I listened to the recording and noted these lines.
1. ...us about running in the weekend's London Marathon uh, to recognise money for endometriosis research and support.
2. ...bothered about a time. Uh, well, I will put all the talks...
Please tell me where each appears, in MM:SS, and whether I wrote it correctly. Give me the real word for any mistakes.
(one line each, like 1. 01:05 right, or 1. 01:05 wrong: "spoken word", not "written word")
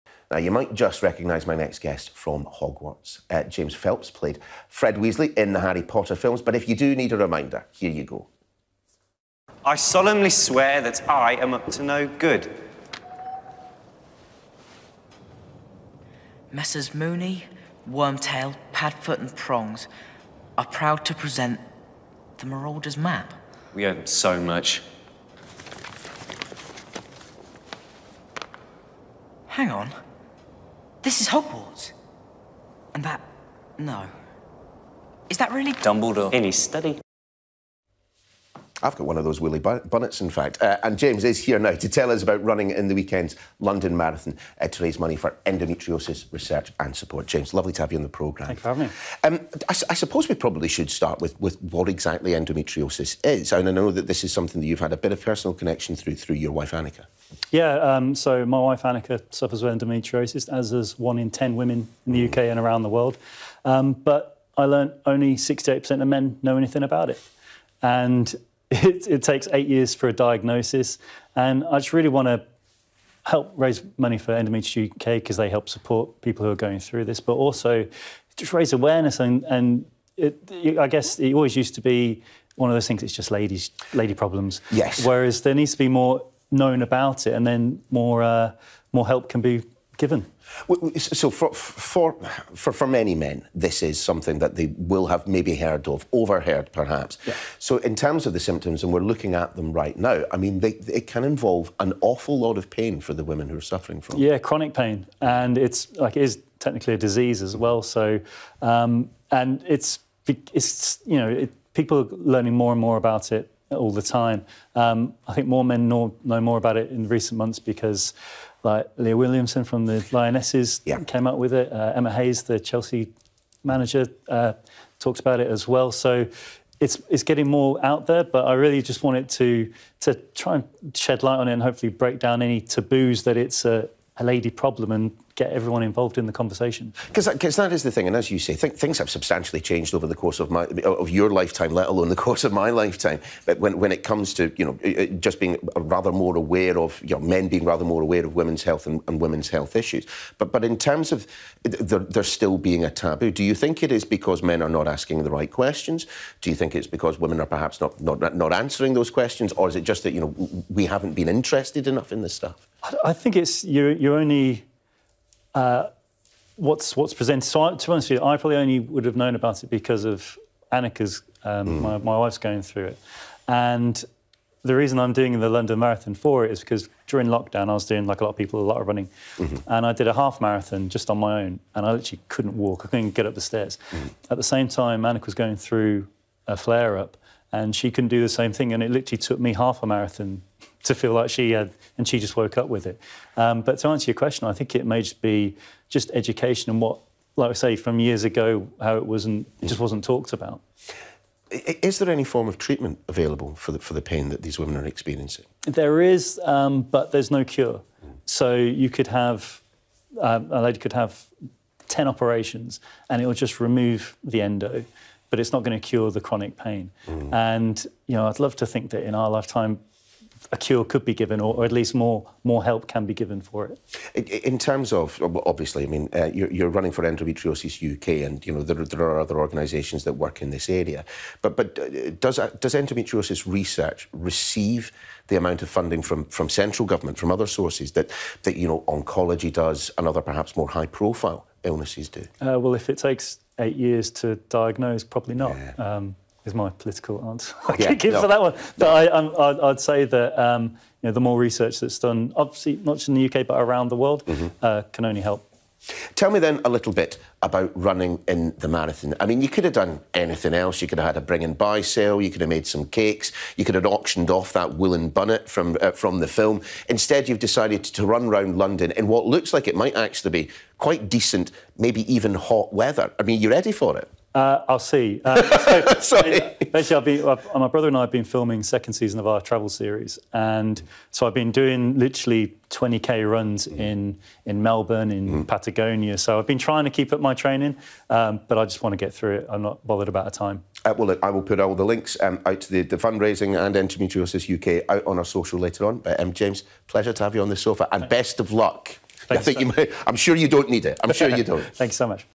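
1. 00:42 wrong: "raise", not "recognise"
2. 04:49 wrong: "links", not "talks".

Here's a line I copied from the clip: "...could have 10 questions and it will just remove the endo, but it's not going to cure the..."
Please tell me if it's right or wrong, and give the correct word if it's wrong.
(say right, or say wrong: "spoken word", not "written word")
wrong: "operations", not "questions".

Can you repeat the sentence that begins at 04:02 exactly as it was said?
Uh, well, if it takes eight years to diagnose, probably not.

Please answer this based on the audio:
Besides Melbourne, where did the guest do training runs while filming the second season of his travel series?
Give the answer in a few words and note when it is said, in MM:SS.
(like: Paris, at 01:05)
Patagonia, at 04:45.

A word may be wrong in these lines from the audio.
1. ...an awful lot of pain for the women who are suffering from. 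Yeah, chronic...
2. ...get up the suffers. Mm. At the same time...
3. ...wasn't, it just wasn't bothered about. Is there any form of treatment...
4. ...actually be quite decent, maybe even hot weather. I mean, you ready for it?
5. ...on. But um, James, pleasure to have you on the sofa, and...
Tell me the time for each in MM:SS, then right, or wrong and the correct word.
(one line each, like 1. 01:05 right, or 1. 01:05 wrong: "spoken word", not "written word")
1. 01:41 right
2. 03:03 wrong: "stairs", not "suffers"
3. 03:19 wrong: "talked", not "bothered"
4. 04:29 right
5. 04:55 right.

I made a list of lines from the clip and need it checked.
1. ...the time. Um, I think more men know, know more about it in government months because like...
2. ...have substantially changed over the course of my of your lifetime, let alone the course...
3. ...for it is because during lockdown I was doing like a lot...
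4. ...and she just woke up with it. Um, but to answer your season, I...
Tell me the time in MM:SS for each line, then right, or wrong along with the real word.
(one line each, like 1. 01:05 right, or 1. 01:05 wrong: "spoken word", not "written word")
1. 01:53 wrong: "recent", not "government"
2. 02:18 right
3. 02:56 right
4. 03:11 wrong: "question", not "season".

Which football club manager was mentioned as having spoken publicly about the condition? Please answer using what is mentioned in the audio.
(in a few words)
Emma Hayes.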